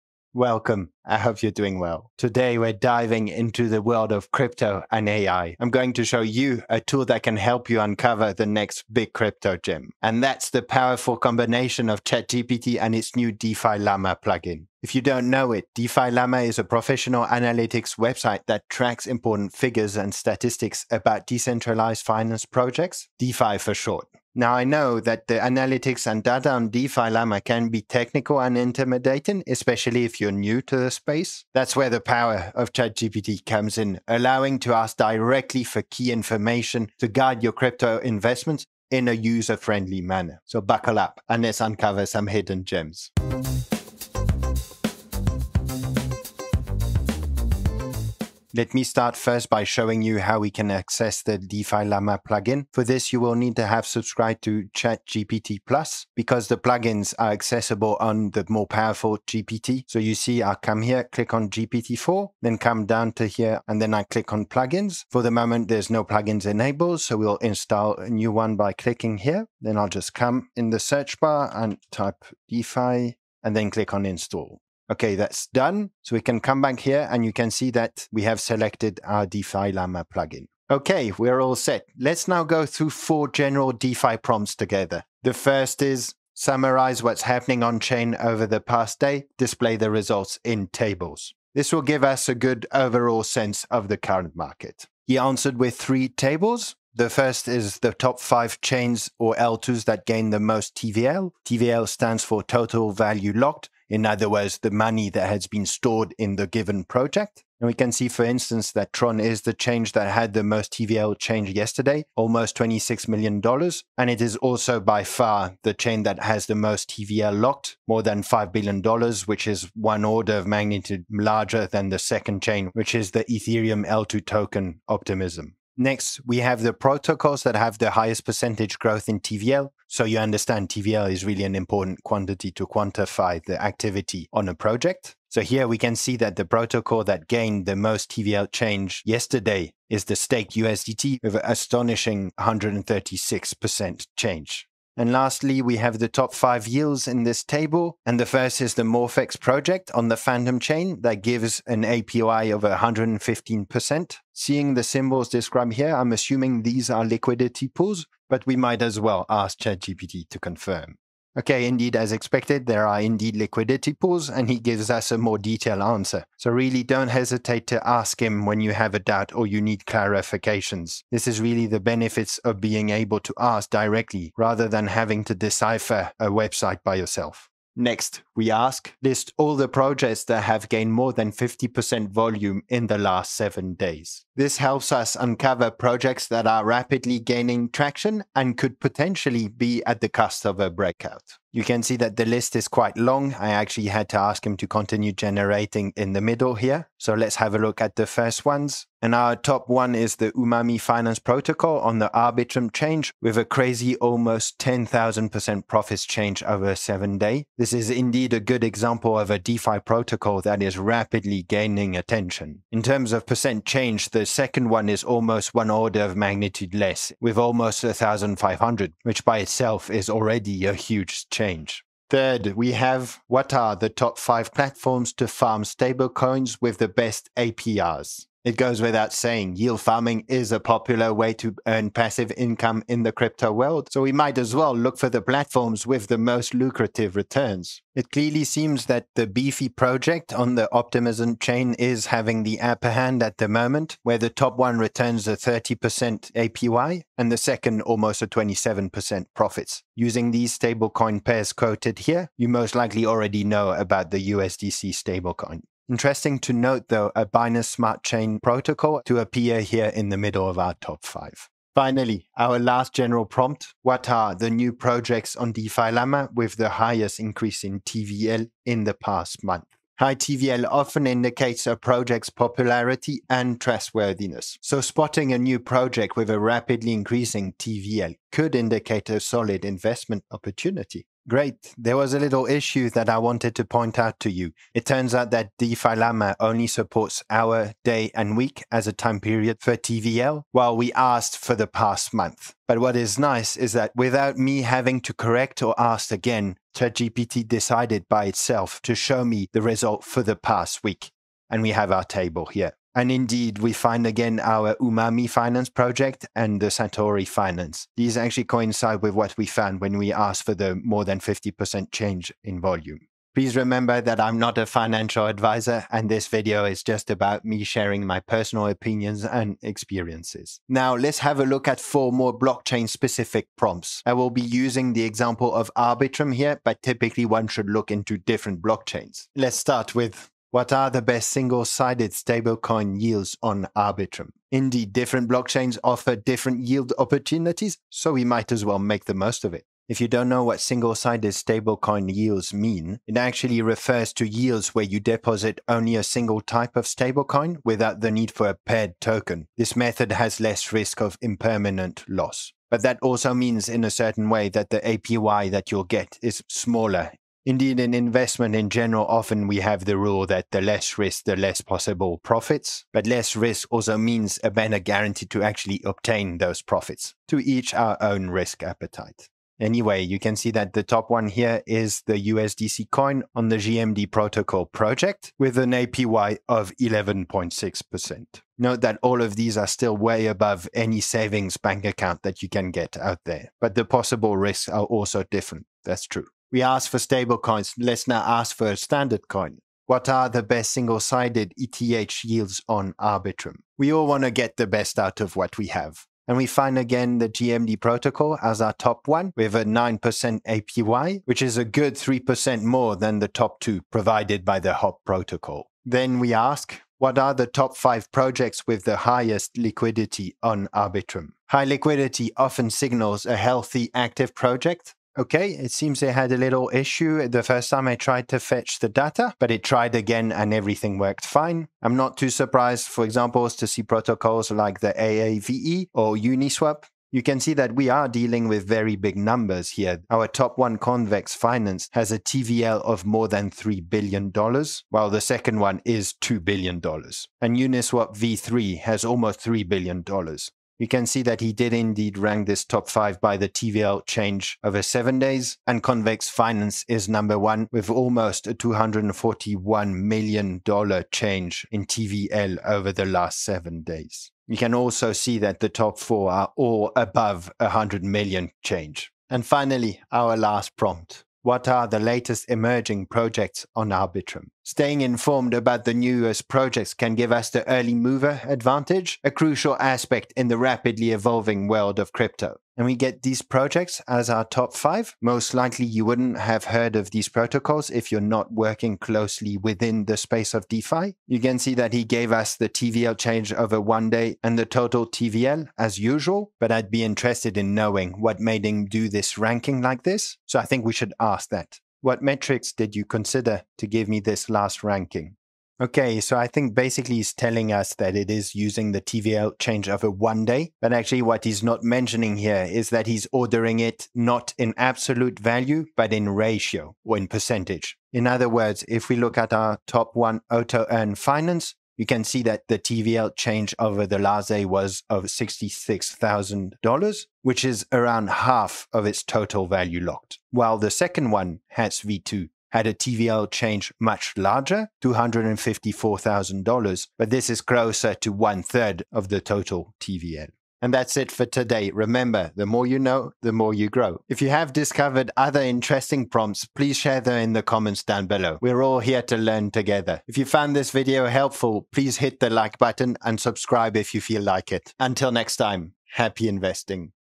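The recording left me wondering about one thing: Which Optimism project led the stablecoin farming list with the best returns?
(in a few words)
Beefy.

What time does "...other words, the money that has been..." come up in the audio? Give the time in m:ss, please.
1:44.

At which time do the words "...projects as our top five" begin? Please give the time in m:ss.
7:53.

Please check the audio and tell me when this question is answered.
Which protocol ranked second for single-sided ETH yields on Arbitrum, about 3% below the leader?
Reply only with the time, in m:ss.
6:44.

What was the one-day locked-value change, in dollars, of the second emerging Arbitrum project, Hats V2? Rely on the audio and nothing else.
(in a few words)
$254,000.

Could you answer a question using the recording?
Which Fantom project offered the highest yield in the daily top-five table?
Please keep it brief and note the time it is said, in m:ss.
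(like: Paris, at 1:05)
Morphex, at 2:28.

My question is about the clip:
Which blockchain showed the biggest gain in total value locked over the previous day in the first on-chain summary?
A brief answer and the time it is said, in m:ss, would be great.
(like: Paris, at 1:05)
Tron, at 1:48.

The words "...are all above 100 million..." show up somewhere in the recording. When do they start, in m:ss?
7:36.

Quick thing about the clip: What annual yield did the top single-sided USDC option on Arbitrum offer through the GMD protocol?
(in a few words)
11.6%.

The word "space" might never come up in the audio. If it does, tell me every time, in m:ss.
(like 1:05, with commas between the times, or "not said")
0:30, 8:00.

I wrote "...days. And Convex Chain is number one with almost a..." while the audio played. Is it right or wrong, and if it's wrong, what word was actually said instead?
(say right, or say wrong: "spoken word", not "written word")
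wrong: "Finance", not "Chain".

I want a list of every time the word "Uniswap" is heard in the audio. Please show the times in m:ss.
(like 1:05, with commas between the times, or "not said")
7:06, 7:17.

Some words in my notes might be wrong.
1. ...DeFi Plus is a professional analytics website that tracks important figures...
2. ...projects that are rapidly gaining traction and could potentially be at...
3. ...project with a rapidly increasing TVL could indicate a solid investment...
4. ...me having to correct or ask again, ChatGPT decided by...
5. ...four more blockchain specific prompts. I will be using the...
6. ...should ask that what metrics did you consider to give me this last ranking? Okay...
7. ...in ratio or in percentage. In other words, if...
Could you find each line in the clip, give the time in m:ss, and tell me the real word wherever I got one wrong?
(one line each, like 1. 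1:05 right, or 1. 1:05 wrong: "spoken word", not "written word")
1. 0:15 wrong: "Llama", not "Plus"
2. 3:05 right
3. 4:35 right
4. 4:54 right
5. 5:21 right
6. 8:10 right
7. 8:26 right.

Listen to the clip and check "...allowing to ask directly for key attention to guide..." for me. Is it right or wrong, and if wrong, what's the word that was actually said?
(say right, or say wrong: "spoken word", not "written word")
wrong: "information", not "attention".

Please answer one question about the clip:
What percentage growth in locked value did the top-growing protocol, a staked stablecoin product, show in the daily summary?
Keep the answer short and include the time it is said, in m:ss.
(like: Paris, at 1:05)
136%, at 2:22.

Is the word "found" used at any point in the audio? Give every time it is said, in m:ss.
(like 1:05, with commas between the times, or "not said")
5:09, 9:00.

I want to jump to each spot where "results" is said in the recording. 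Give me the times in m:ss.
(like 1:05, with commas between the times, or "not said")
1:29, 4:59.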